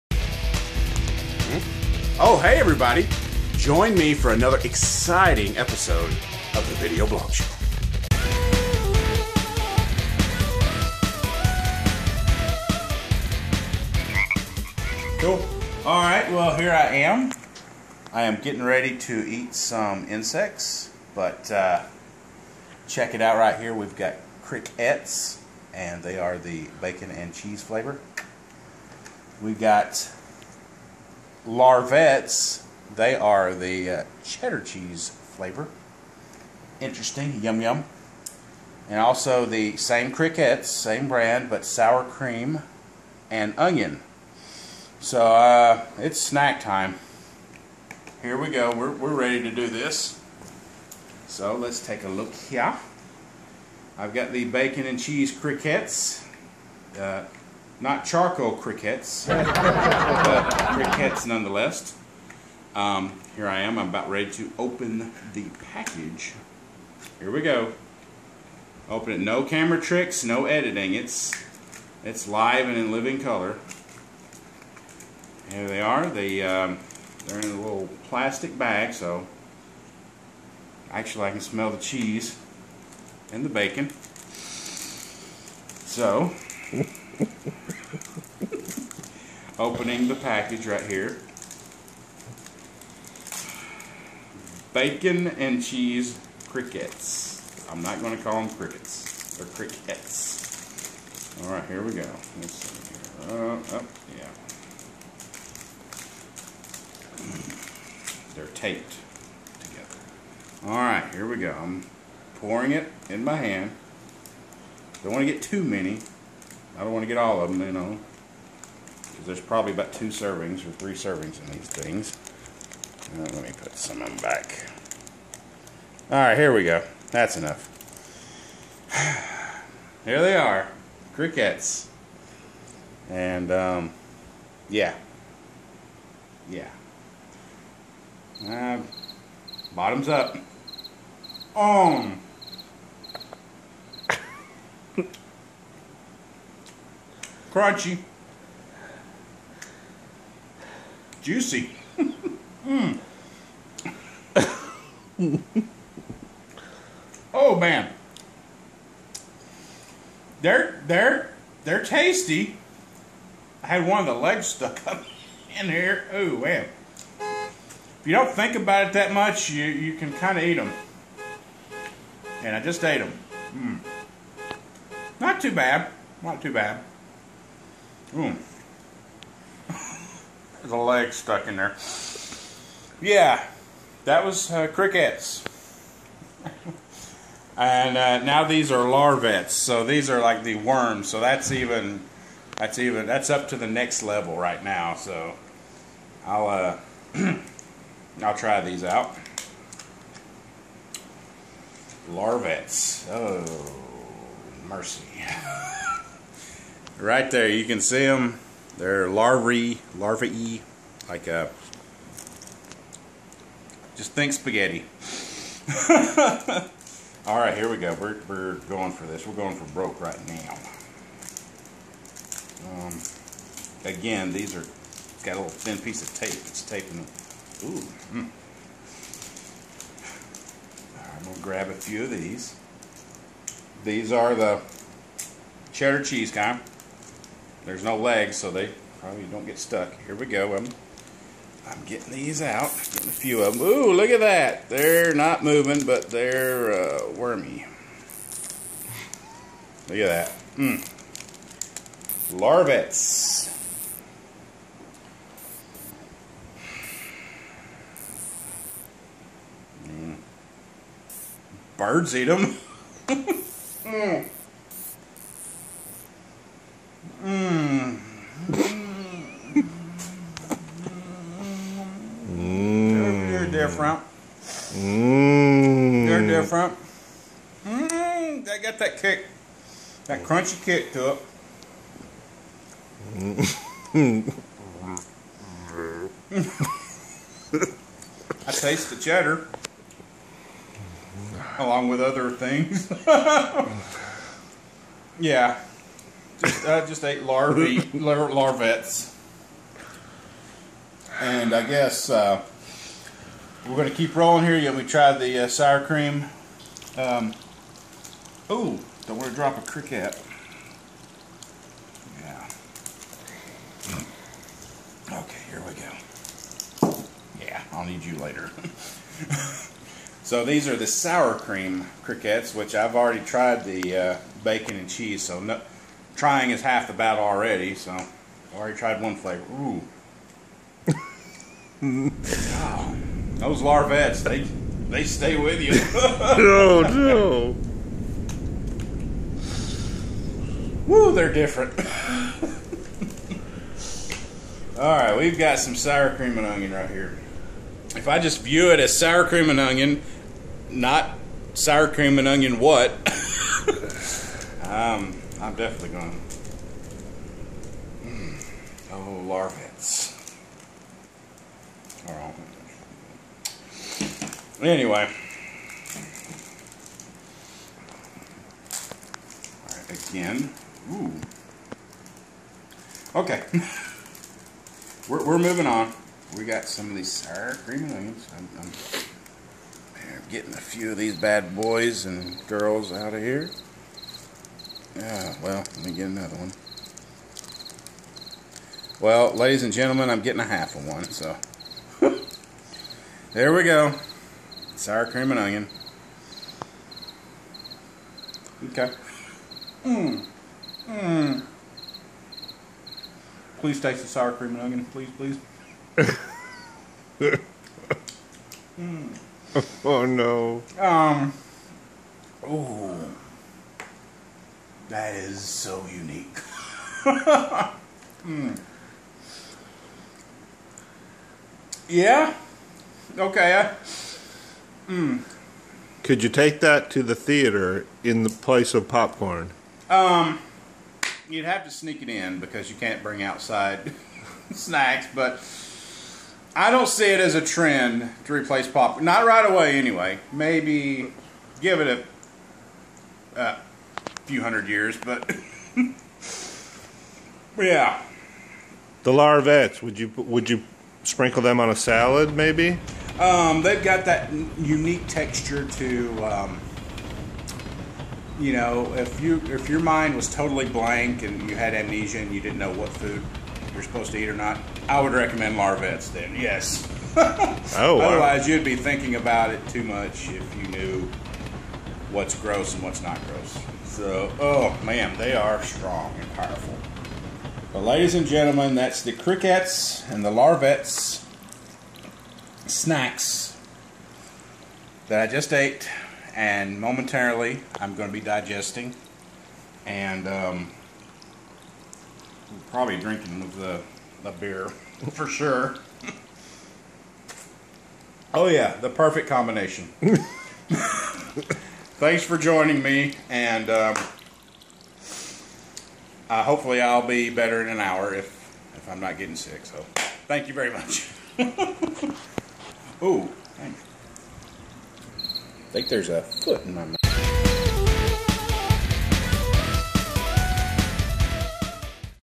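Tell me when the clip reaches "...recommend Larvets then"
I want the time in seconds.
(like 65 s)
465 s.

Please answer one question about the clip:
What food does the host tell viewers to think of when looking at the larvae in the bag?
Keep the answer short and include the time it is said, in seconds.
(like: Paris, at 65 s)
spaghetti, at 214 s.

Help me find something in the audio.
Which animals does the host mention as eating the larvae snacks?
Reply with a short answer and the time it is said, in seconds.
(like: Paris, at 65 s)
birds, at 261 s.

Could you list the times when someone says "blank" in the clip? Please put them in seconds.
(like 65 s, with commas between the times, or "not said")
460 s.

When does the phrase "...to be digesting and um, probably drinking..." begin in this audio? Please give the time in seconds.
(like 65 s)
488 s.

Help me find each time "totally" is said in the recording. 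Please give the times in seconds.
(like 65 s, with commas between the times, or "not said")
460 s.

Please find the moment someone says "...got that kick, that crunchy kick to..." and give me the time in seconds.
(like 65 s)
278 s.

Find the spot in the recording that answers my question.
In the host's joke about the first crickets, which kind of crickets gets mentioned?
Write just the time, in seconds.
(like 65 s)
58 s.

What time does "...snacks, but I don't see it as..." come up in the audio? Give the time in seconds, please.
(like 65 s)
434 s.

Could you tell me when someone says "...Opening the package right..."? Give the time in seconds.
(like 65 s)
89 s.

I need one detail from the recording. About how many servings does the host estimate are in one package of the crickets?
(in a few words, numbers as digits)
3.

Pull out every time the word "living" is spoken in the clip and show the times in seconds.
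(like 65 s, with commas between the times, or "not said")
72 s.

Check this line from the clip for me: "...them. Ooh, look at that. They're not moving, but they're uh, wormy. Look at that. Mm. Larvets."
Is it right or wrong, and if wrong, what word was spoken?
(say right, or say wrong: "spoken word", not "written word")
right.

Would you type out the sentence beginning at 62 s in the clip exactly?
Um, here I am, I'm about ready to open the package.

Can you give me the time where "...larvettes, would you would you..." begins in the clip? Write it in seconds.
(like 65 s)
449 s.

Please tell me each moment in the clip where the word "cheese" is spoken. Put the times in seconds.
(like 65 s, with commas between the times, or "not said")
27 s, 34 s, 54 s, 81 s, 95 s, 236 s, 324 s.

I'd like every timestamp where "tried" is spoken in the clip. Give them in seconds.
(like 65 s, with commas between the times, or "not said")
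323 s, 328 s.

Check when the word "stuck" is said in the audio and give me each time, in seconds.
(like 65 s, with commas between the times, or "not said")
164 s, 181 s, 239 s.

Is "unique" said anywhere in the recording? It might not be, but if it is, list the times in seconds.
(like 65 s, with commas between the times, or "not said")
415 s, 454 s.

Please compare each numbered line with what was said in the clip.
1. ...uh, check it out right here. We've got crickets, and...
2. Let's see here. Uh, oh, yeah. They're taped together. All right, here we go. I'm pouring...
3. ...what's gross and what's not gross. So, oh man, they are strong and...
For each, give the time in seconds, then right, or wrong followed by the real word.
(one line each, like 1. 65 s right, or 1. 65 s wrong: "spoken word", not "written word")
1. 21 s right
2. 102 s right
3. 472 s right.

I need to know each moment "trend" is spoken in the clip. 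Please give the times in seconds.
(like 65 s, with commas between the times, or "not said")
437 s.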